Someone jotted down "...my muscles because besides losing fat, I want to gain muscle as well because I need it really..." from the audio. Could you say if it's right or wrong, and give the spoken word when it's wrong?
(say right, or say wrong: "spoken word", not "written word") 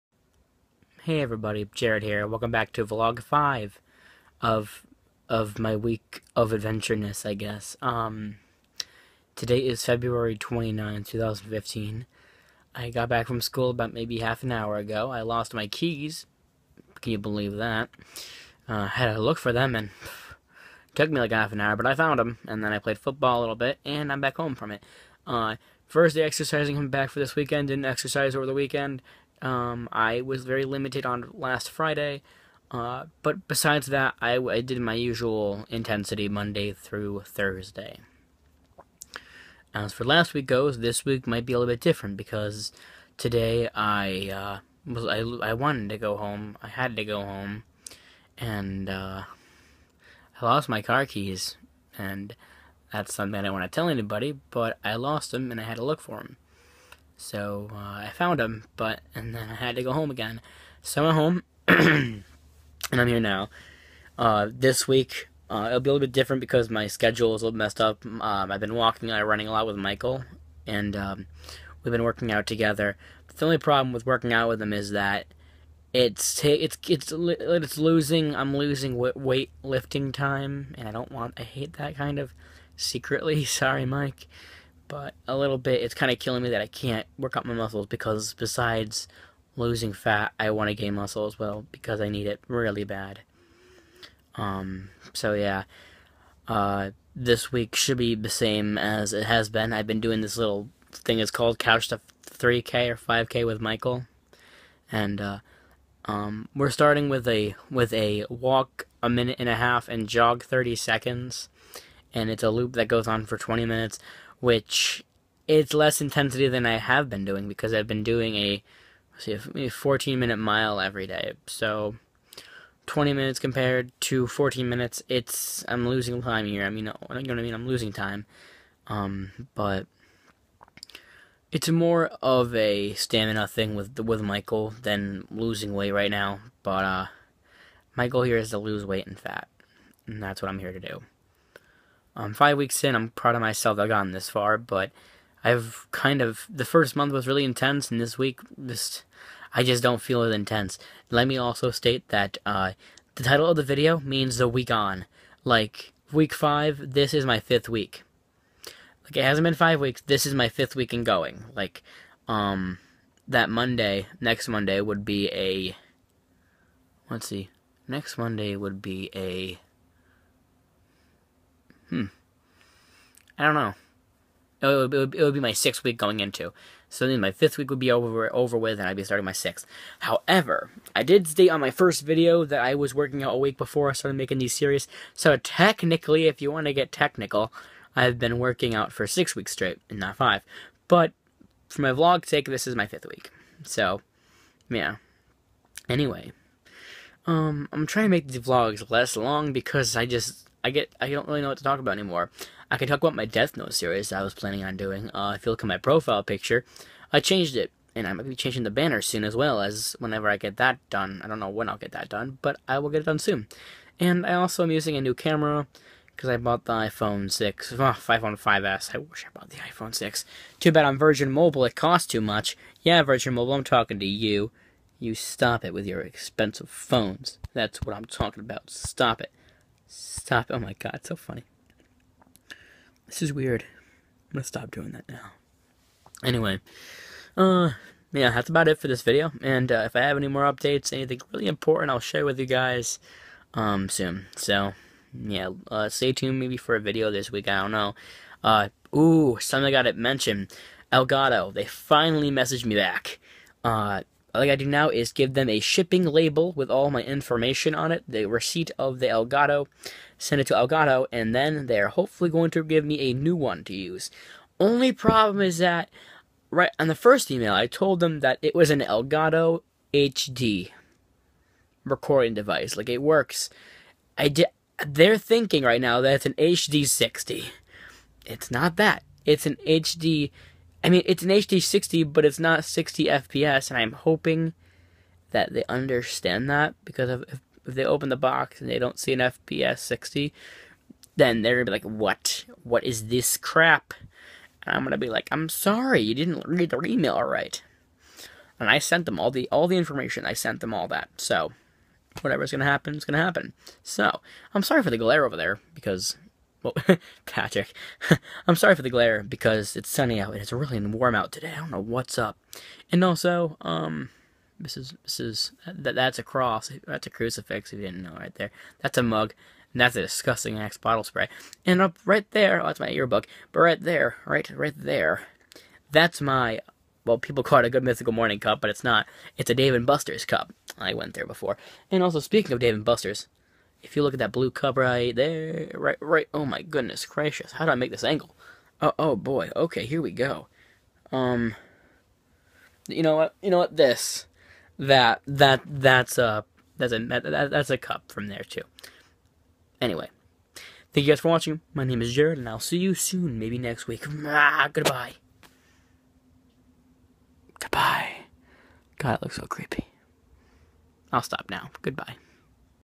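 right.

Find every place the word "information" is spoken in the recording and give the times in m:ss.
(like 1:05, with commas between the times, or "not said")
4:17, 4:59.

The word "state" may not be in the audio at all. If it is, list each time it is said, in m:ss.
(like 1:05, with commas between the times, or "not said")
2:31, 3:01.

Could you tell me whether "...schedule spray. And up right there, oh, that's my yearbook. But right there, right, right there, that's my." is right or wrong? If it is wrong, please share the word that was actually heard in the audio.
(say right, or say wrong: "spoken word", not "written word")
wrong: "bottle", not "schedule".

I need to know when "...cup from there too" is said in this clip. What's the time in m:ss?
5:47.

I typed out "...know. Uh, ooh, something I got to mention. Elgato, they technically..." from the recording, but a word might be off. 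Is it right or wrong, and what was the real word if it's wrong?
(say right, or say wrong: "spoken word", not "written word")
wrong: "finally", not "technically".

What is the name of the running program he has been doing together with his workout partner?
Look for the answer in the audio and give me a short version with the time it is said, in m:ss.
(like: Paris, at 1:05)
Couch to 3K or 5K, at 1:41.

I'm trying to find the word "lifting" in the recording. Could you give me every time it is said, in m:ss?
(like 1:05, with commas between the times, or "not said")
1:19.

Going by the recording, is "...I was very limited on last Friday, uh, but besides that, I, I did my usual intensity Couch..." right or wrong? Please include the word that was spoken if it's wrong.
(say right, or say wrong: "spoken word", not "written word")
wrong: "Monday", not "Couch".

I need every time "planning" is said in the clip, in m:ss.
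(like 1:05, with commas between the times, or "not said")
3:24.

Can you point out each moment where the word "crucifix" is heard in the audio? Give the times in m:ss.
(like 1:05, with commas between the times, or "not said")
5:17.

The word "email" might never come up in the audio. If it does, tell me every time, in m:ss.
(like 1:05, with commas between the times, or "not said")
4:27, 4:56.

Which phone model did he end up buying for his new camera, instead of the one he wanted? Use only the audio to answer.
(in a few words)
iPhone 5S.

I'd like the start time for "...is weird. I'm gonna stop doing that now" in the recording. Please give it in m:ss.
3:53.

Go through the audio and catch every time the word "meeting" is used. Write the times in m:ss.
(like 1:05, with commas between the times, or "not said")
not said.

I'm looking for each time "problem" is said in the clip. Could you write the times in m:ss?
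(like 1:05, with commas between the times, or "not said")
1:13, 4:24.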